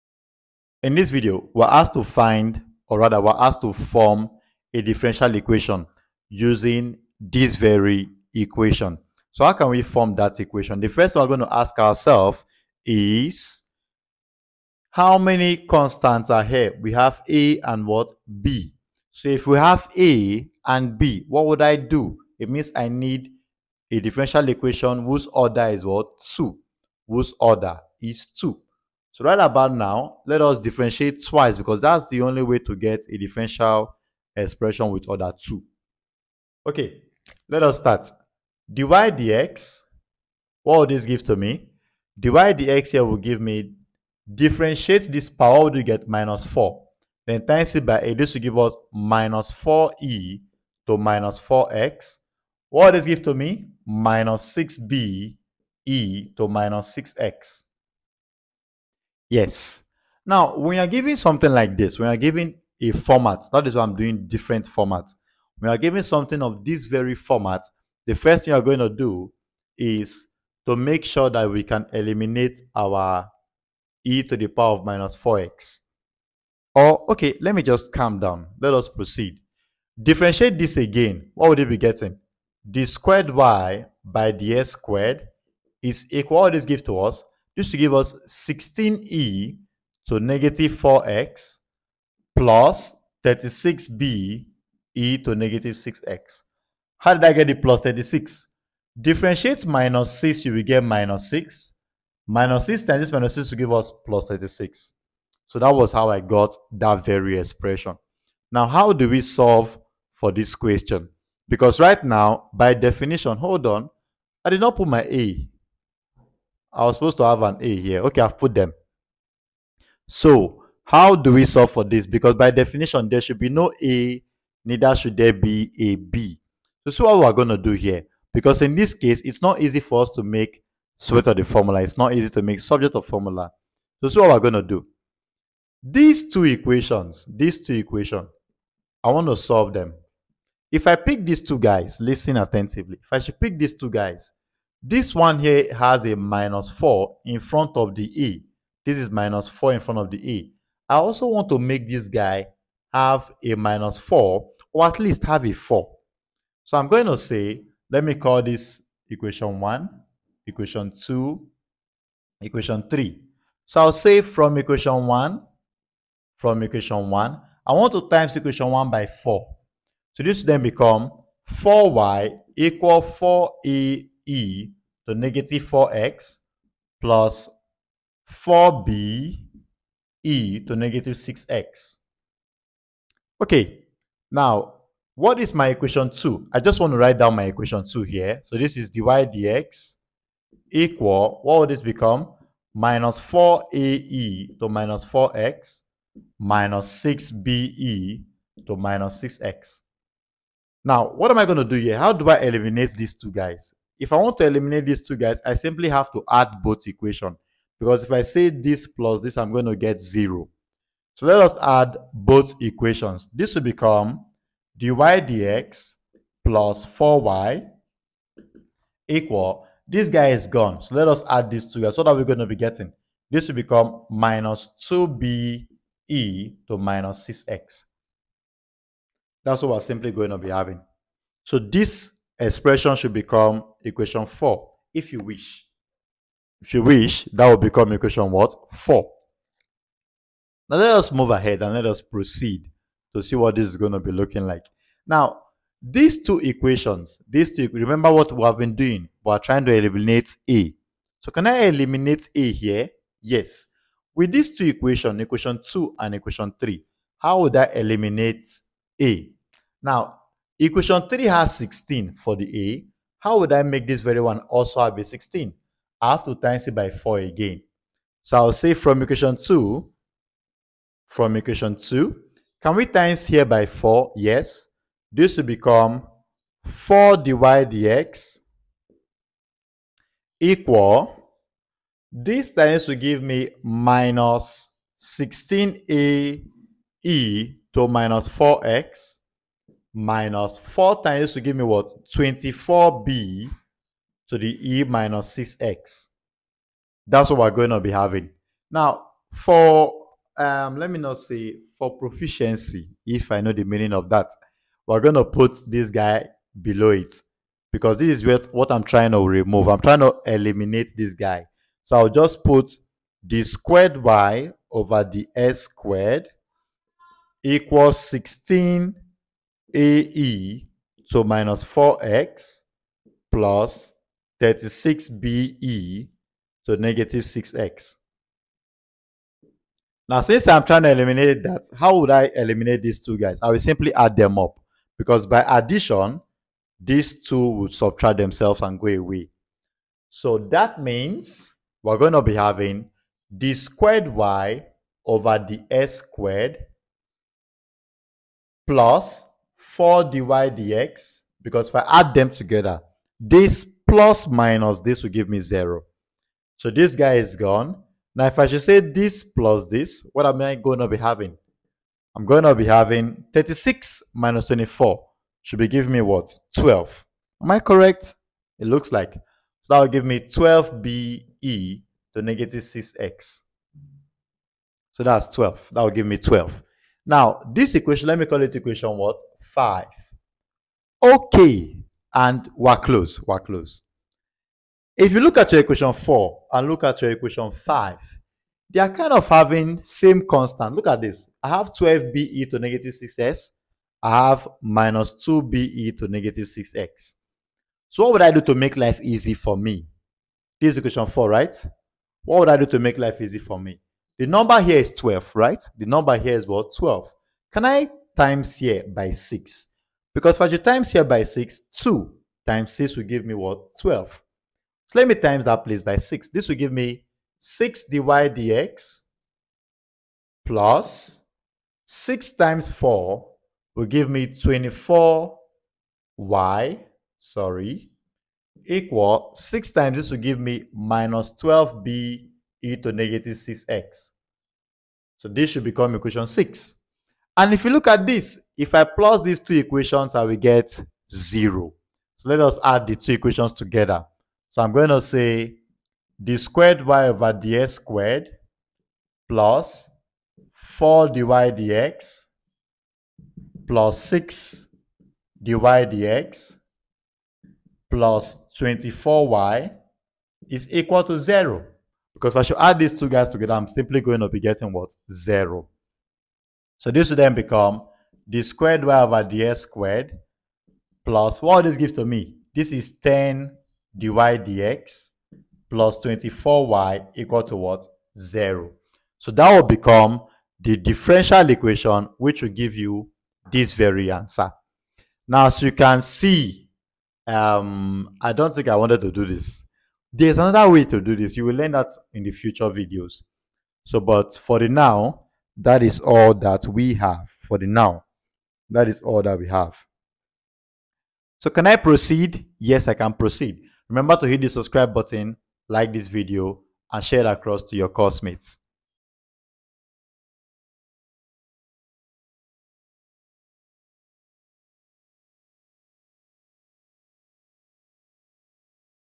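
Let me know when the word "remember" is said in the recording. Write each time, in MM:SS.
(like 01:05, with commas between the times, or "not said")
04:07, 08:23.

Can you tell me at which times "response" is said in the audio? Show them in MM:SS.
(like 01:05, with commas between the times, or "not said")
not said.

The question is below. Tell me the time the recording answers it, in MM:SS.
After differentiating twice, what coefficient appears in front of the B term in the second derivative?
01:32.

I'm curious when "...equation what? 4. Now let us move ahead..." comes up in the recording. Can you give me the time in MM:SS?
03:57.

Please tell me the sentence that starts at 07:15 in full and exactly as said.
So this should become equation 6.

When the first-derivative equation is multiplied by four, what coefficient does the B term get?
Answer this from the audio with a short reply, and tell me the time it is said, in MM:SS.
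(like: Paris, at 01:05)
-24, at 04:52.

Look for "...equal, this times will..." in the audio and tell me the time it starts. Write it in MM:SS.
04:40.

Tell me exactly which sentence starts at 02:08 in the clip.
Because in this case, it's not easy for us to make subject of the formula.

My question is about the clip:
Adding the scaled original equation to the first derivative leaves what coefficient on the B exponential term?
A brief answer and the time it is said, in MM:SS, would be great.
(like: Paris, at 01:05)
-2, at 03:44.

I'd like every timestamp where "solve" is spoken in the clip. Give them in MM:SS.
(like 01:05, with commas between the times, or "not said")
01:49, 02:01, 02:19.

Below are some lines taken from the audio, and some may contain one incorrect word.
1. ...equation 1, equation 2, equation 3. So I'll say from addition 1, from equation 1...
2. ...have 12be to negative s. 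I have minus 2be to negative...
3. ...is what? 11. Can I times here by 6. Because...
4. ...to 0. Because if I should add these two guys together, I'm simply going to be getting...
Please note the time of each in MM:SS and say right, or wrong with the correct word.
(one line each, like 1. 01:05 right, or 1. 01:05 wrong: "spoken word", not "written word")
1. 02:39 wrong: "equation", not "addition"
2. 06:31 right
3. 06:46 wrong: "12", not "11"
4. 07:41 right.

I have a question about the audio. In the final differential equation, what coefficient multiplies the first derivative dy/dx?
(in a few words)
10.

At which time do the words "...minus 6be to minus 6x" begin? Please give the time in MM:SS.
03:16.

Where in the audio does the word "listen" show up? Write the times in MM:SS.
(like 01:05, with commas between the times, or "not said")
02:21.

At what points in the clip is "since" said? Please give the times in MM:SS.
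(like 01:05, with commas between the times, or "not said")
05:30.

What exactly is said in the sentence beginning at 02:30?
I also want to make this guy have a minus 4 or at least have a 4.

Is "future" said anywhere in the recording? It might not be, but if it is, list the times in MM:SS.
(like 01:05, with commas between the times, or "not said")
08:12.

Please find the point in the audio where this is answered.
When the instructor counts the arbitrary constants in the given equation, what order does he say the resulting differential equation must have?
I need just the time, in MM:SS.
00:27.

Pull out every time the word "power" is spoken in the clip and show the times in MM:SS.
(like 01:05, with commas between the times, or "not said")
00:45, 01:14.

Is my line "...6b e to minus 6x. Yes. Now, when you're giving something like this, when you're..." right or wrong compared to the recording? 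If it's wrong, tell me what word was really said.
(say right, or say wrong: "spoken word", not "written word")
right.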